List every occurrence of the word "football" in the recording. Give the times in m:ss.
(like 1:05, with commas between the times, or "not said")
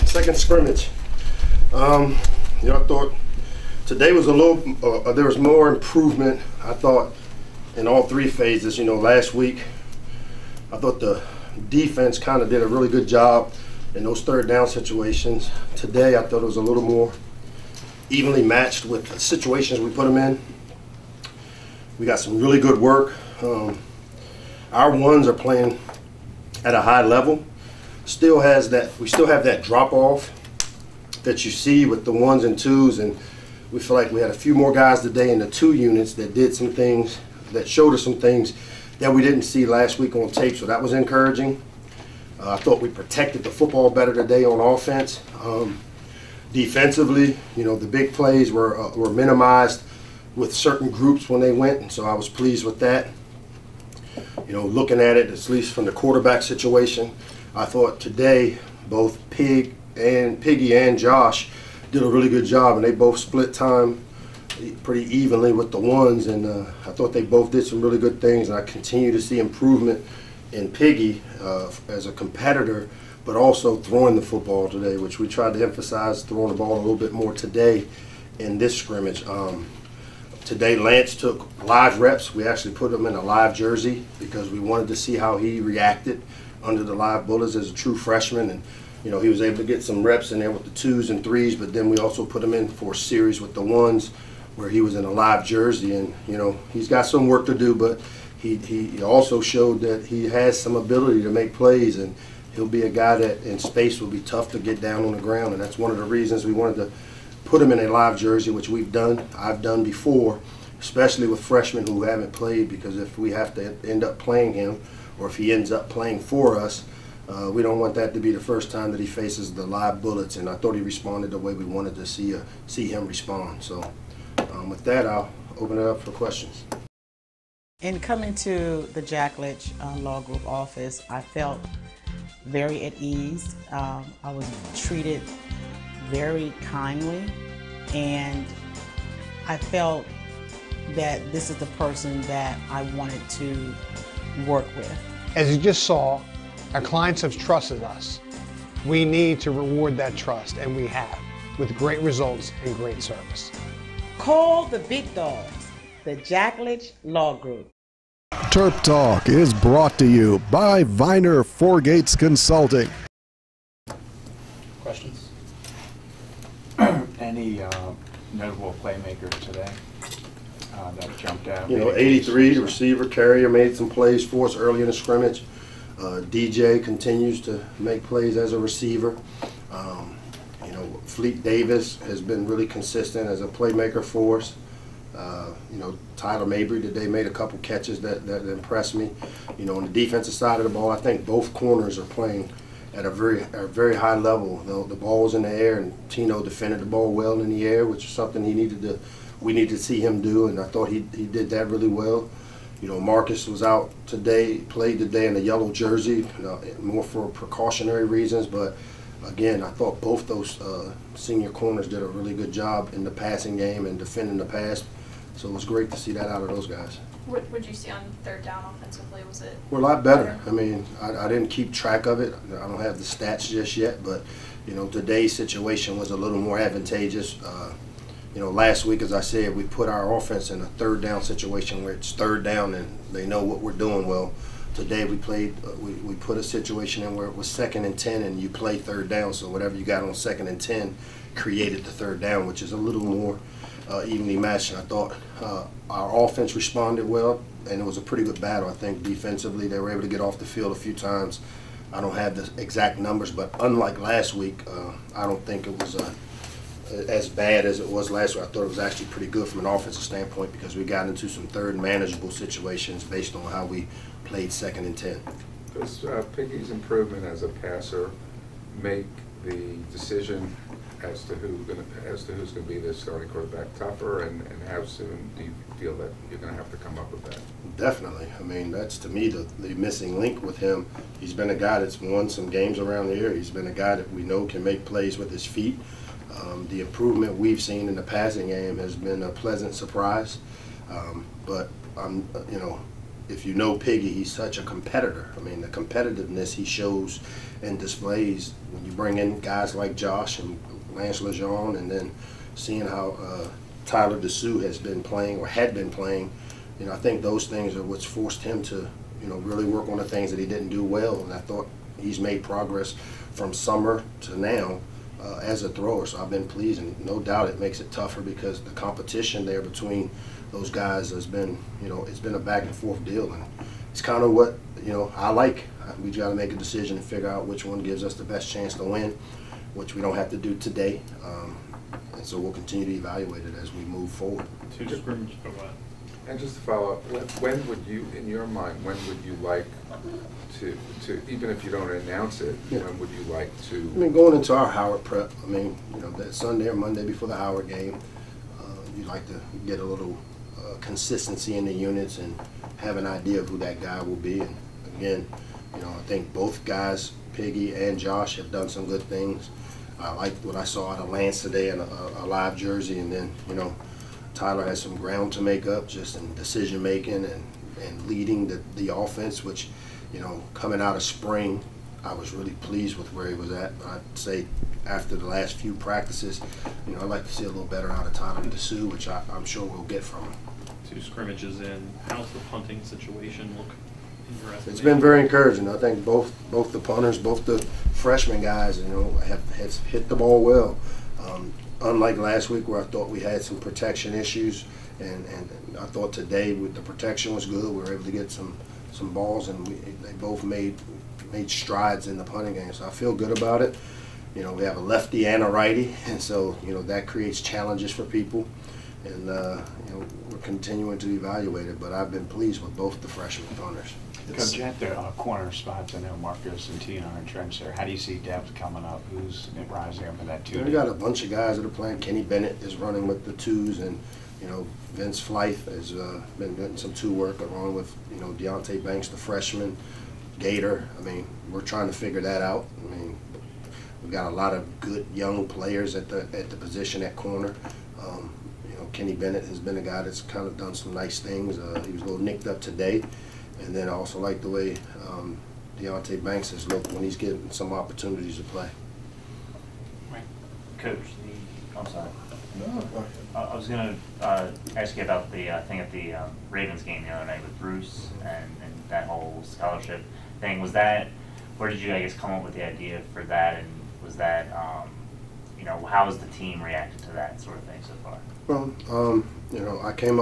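0:43, 1:14.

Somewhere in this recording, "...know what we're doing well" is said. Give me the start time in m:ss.
3:53.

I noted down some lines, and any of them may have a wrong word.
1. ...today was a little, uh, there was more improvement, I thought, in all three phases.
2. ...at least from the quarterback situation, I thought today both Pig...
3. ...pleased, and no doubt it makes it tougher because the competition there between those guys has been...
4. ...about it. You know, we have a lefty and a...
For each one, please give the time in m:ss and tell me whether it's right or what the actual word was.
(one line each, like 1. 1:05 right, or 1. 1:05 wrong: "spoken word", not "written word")
1. 0:03 right
2. 0:55 right
3. 5:16 right
4. 6:43 right.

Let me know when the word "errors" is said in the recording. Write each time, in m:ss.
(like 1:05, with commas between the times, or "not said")
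not said.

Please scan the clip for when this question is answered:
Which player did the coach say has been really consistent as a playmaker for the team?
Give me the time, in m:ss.
3:01.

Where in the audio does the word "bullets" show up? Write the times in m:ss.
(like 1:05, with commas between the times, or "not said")
1:27, 2:00.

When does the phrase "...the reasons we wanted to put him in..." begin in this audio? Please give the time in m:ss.
1:45.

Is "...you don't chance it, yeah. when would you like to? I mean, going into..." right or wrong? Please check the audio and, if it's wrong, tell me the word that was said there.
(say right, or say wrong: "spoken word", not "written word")
wrong: "announce", not "chance".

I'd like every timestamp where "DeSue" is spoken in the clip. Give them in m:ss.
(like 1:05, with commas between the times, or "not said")
5:04, 6:18.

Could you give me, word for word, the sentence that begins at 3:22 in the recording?
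You know, Marcus was out today, played today in a yellow jersey, more for precautionary reasons.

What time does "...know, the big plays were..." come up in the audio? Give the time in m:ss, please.
0:47.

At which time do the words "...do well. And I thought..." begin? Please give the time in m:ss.
5:10.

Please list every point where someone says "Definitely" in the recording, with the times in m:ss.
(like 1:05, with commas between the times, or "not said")
4:37.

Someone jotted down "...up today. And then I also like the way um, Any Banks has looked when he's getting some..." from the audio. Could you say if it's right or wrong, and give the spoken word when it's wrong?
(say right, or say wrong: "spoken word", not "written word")
wrong: "Deonte", not "Any".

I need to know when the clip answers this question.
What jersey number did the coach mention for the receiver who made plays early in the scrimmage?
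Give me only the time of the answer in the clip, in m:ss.
2:51.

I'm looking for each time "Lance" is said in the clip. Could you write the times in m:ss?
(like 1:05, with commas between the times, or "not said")
1:20, 5:00, 6:01.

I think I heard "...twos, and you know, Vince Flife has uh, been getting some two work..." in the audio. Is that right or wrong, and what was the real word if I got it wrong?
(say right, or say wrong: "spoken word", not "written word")
right.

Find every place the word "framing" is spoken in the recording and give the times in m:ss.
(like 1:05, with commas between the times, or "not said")
not said.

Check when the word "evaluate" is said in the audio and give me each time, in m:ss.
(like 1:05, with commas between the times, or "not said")
5:32, 6:51.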